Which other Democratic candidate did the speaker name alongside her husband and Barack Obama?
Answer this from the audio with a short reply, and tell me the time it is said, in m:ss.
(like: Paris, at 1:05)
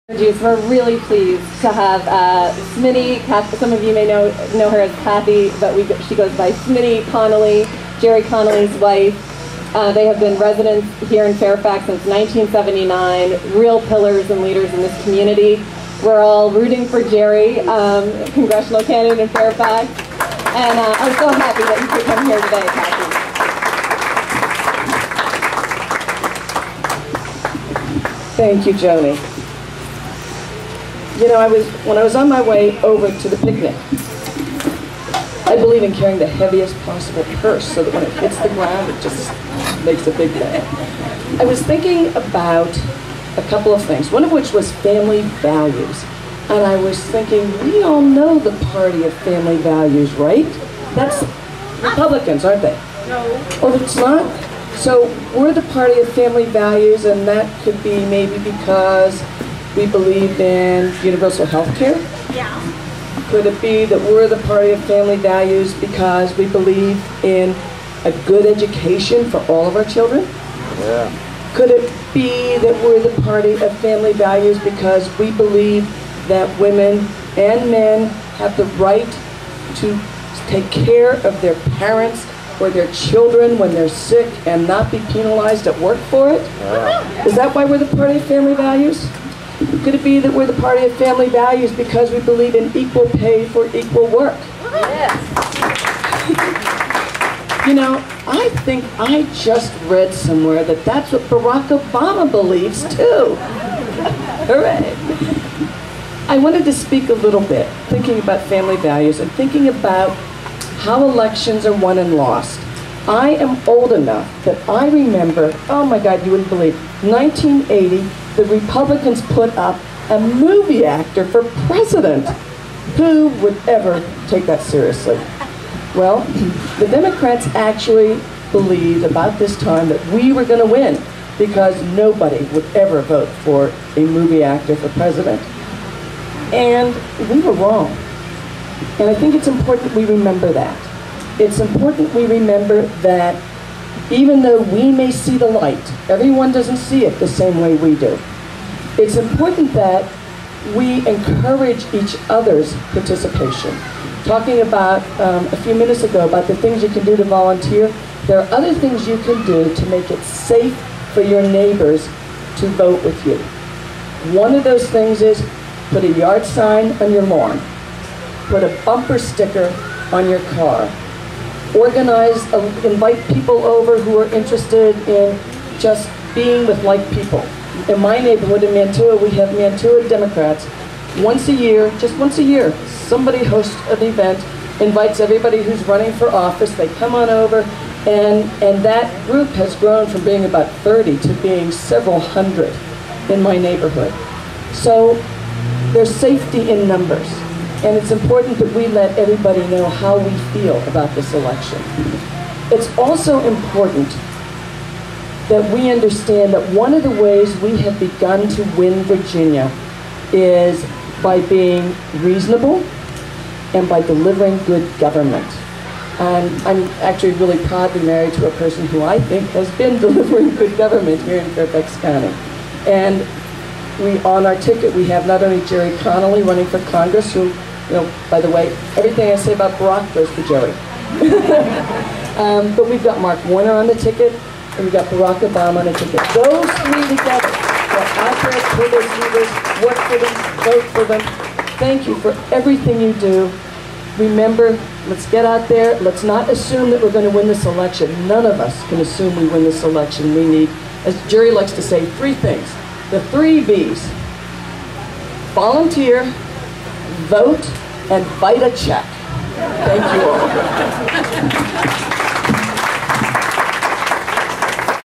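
Mark Warner, at 3:53.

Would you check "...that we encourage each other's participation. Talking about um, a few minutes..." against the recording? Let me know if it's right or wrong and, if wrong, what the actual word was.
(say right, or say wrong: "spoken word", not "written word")
right.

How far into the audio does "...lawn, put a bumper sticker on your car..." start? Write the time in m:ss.
2:47.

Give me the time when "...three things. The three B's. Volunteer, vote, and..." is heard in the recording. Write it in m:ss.
4:12.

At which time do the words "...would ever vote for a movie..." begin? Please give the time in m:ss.
2:12.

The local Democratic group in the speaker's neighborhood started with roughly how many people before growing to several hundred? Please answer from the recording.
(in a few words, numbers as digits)
30.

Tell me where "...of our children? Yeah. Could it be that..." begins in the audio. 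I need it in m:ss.
1:09.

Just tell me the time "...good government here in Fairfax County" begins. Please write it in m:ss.
3:40.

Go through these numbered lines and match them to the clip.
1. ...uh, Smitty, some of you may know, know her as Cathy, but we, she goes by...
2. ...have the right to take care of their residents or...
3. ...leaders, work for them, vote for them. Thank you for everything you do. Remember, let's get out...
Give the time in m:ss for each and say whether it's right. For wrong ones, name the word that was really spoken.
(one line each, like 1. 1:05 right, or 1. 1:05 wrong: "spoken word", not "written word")
1. 0:02 right
2. 1:18 wrong: "parents", not "residents"
3. 3:59 right.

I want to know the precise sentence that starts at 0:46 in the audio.
And I was thinking, we all know the party of family values, right?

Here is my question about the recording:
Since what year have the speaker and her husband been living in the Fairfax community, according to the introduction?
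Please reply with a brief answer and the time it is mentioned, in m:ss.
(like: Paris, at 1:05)
1979, at 0:12.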